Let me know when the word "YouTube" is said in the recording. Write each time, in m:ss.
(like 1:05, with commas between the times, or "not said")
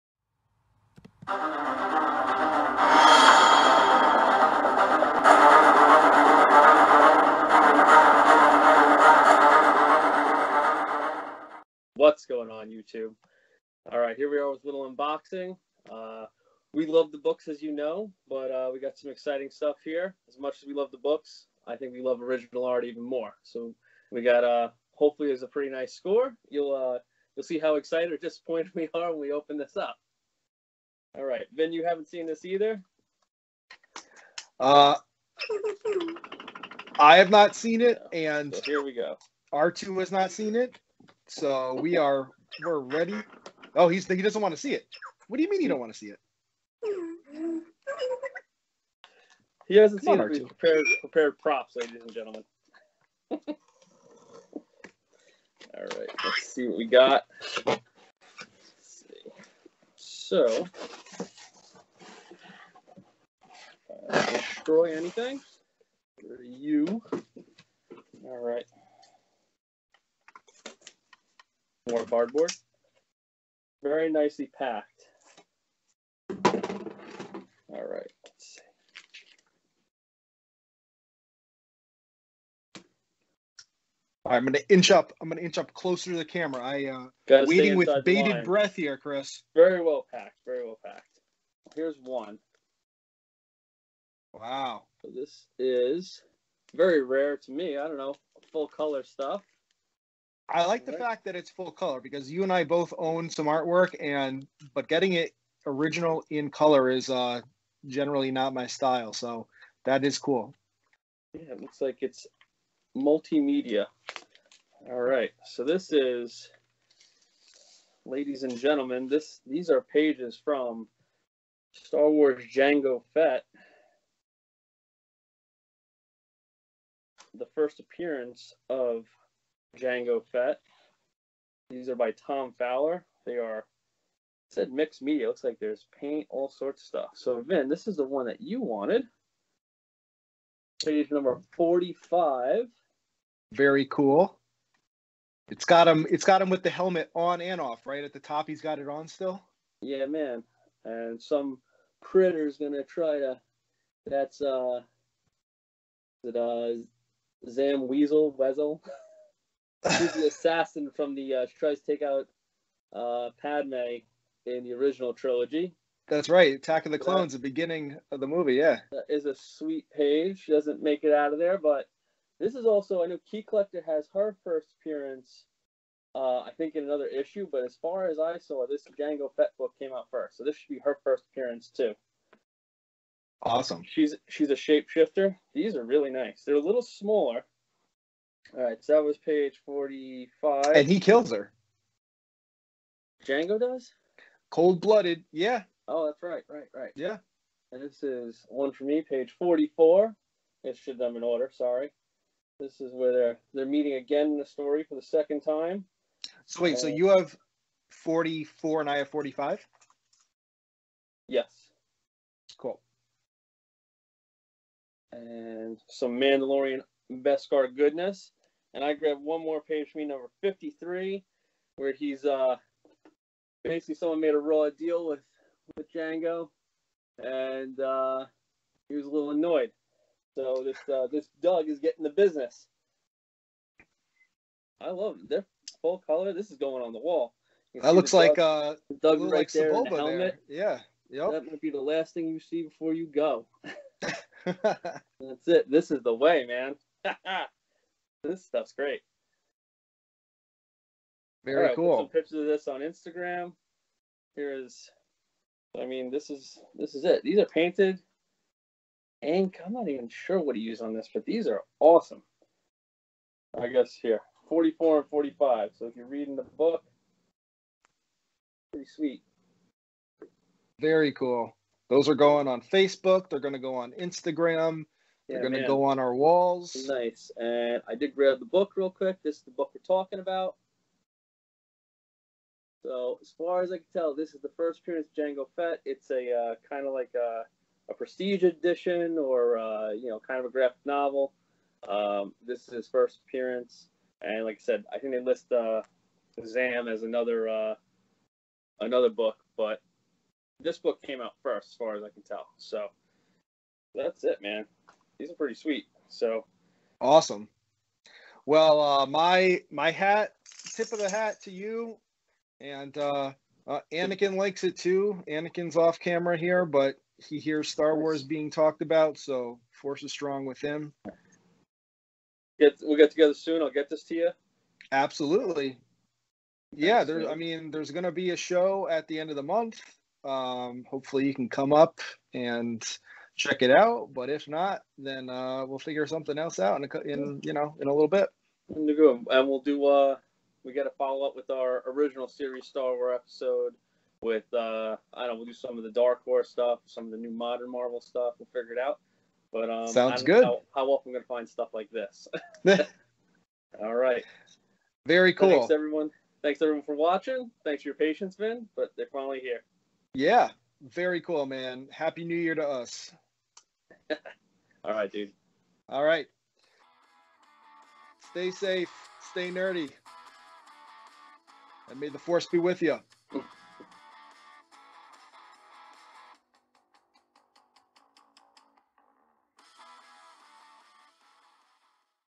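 0:12.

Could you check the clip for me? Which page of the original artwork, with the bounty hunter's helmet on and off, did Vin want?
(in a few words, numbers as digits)
45.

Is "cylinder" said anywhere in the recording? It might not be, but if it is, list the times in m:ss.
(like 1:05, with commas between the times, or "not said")
not said.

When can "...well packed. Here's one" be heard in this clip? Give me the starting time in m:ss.
1:30.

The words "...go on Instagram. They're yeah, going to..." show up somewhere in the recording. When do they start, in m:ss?
4:33.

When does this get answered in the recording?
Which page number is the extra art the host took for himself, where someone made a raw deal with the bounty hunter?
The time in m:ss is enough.
3:40.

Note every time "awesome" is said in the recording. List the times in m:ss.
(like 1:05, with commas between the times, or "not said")
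3:03, 4:21, 5:06.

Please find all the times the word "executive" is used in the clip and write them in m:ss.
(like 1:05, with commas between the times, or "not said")
not said.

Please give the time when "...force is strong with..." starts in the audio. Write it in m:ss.
5:19.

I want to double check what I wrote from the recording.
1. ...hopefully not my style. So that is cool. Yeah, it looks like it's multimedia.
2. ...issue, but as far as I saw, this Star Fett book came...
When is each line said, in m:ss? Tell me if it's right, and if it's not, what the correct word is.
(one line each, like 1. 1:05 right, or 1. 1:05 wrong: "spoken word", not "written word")
1. 1:47 wrong: "generally", not "hopefully"
2. 2:57 wrong: "Jango", not "Star".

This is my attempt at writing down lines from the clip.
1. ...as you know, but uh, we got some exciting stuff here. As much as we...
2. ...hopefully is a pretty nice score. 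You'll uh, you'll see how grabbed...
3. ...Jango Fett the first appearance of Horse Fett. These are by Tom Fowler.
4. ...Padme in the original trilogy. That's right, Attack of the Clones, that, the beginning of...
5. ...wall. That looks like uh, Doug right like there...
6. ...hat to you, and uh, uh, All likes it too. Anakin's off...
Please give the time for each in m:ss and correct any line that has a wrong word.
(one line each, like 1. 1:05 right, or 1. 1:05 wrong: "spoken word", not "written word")
1. 0:17 right
2. 0:24 wrong: "excited", not "grabbed"
3. 2:02 wrong: "Jango", not "Horse"
4. 2:43 right
5. 3:56 right
6. 5:11 wrong: "Anakin", not "All".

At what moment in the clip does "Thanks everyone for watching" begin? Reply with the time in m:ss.
5:56.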